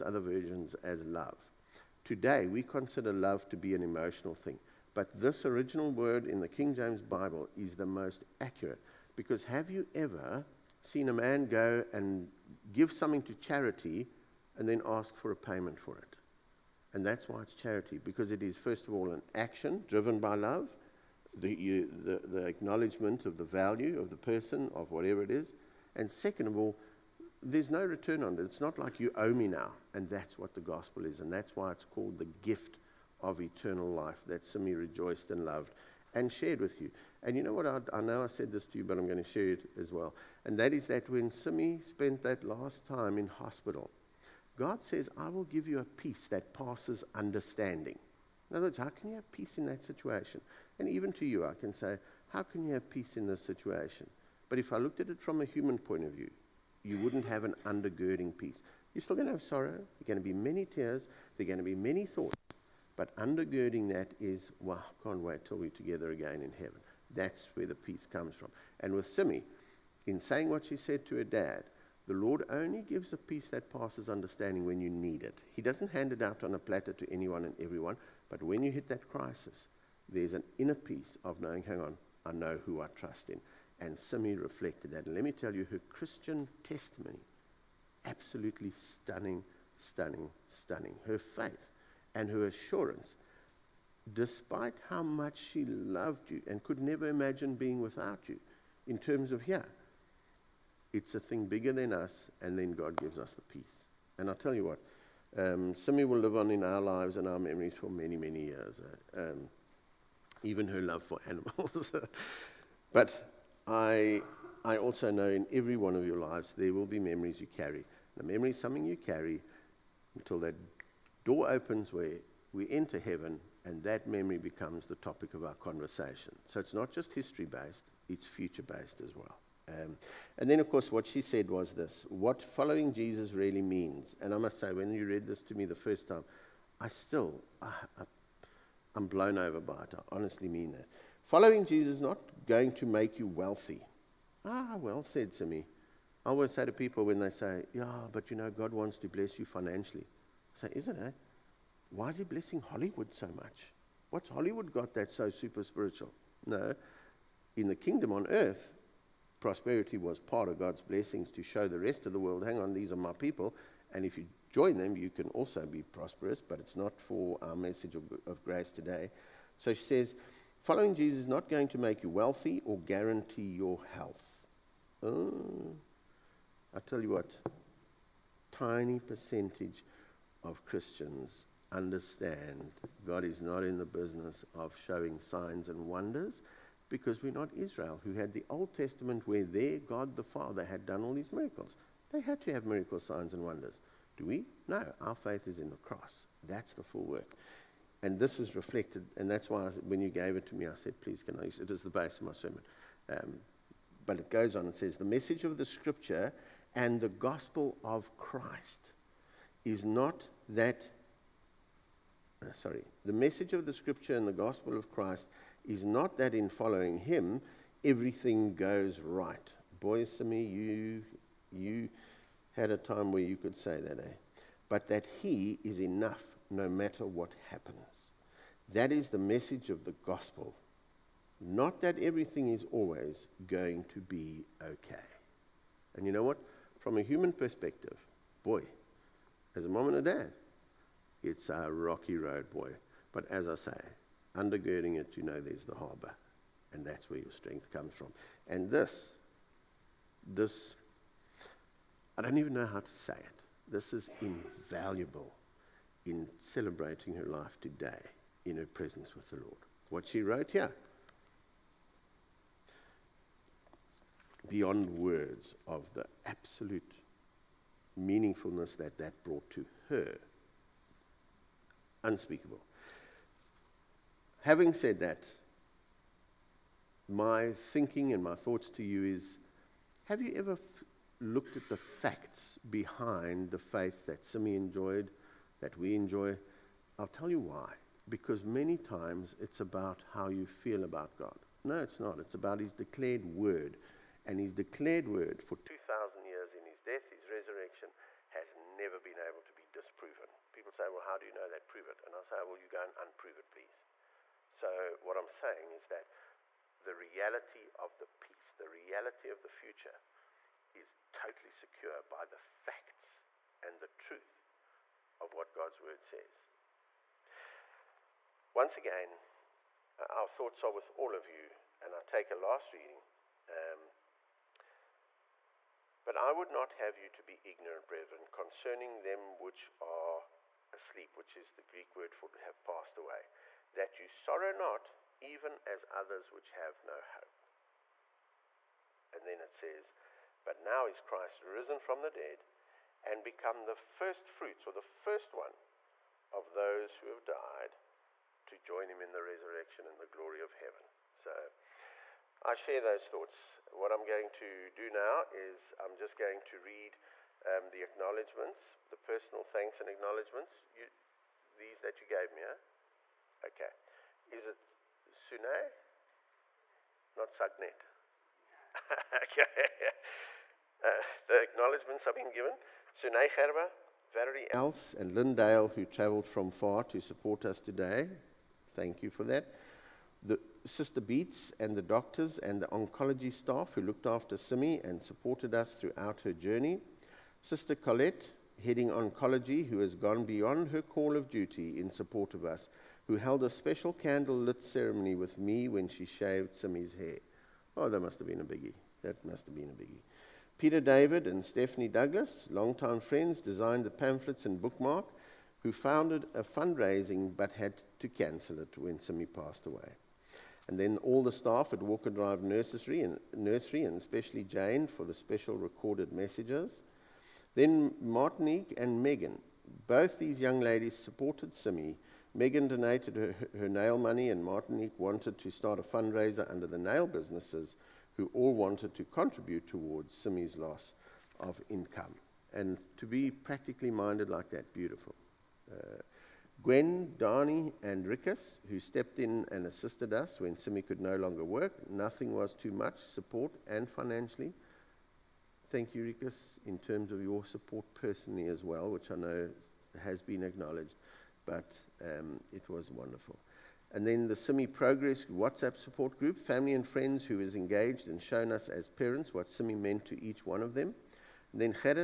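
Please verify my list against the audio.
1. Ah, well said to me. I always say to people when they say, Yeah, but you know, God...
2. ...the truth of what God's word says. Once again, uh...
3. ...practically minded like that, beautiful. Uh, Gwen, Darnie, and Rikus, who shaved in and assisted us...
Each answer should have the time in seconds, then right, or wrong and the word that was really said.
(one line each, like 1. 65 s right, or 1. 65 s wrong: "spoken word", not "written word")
1. 144 s right
2. 313 s right
3. 433 s wrong: "stepped", not "shaved".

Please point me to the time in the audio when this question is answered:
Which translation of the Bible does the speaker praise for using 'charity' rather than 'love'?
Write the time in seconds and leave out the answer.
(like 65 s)
6 s.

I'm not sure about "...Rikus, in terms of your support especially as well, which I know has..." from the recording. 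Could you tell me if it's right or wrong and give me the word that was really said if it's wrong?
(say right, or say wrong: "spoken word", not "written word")
wrong: "personally", not "especially".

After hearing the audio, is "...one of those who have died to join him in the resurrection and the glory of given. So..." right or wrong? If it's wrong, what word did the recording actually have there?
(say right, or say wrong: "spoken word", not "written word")
wrong: "heaven", not "given".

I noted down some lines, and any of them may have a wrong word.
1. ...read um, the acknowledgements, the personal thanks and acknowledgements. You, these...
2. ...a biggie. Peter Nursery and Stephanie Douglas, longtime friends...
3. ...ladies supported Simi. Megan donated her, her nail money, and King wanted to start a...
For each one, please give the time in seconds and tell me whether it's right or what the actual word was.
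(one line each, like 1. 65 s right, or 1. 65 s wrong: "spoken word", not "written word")
1. 356 s right
2. 399 s wrong: "David", not "Nursery"
3. 420 s wrong: "Martinique", not "King".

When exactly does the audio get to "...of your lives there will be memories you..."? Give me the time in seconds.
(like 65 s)
115 s.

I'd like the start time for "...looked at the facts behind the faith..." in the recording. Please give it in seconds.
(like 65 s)
281 s.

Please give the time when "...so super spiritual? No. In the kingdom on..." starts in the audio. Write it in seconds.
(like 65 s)
155 s.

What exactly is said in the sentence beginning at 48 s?
In other words, how can you have peace in that situation?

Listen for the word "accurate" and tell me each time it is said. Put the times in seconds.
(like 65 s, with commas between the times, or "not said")
8 s.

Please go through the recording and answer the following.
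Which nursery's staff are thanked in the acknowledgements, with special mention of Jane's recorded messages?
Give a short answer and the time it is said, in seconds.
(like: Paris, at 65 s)
Walker Drive Nursery, at 411 s.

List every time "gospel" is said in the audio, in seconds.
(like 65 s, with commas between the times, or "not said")
30 s, 207 s, 214 s, 230 s.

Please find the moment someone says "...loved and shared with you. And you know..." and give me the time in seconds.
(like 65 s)
35 s.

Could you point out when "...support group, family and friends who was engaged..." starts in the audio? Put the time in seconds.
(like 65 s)
455 s.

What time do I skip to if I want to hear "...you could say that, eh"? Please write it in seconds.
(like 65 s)
223 s.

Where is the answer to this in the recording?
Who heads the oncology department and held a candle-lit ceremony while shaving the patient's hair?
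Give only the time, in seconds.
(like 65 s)
387 s.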